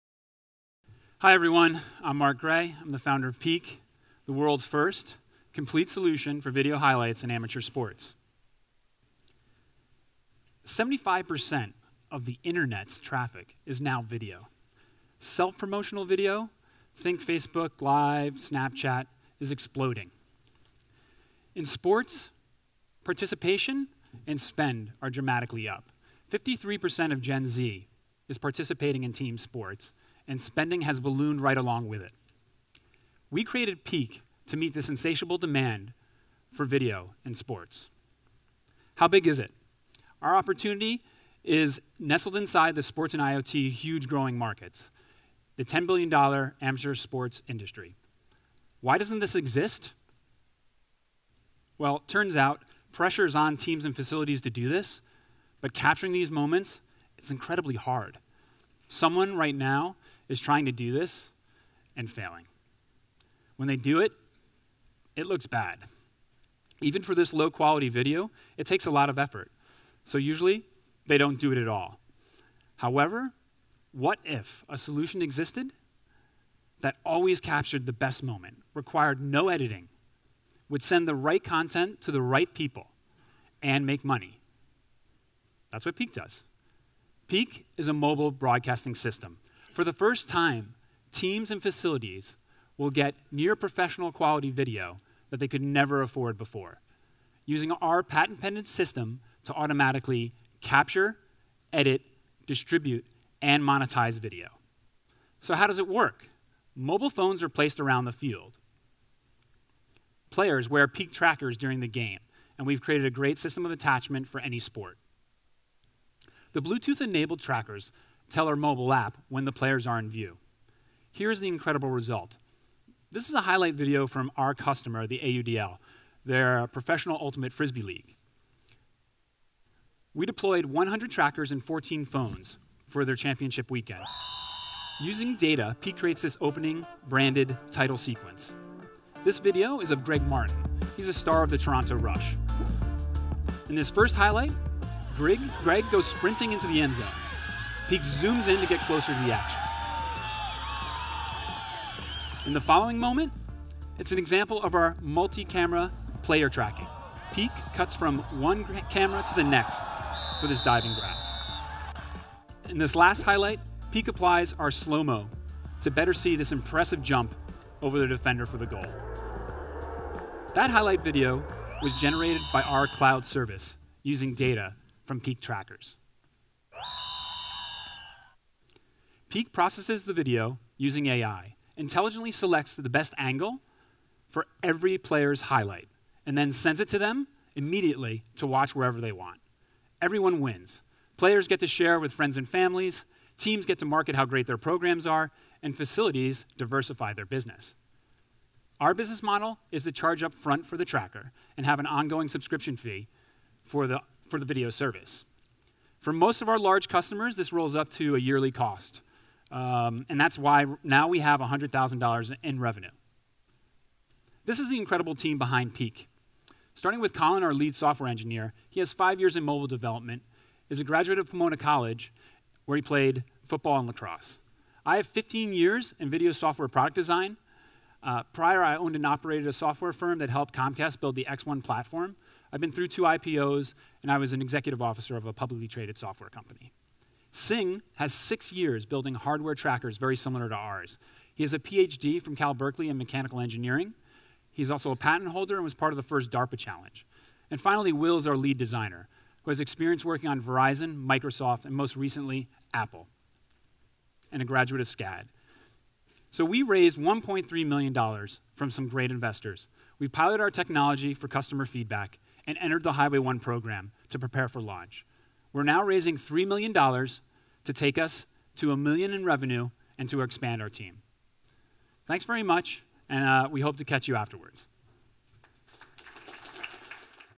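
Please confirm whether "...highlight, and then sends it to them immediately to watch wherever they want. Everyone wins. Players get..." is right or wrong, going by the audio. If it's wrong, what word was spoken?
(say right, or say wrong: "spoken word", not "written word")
right.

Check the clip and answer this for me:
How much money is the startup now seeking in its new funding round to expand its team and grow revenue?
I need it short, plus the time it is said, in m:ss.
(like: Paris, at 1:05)
$3 million, at 4:26.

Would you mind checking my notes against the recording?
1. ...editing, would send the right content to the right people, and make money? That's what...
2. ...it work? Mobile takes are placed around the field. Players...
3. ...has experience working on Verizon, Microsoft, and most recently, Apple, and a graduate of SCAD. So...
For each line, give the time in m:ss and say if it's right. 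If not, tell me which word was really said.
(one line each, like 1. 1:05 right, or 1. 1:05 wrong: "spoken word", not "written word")
1. 1:19 right
2. 1:45 wrong: "phones", not "takes"
3. 4:09 right.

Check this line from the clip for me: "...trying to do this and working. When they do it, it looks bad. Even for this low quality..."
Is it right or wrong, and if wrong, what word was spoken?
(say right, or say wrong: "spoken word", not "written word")
wrong: "failing", not "working".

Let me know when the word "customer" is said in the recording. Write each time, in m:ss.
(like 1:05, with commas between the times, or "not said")
2:04, 3:26, 4:21.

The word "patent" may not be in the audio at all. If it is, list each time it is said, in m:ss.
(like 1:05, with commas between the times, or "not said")
1:38, 4:04.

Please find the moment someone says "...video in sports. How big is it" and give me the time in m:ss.
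0:36.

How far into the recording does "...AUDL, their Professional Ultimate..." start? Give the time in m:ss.
2:05.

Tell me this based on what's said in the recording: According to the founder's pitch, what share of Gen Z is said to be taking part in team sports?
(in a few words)
53%.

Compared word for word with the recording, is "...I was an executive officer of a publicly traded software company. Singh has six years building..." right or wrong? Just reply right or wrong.
right.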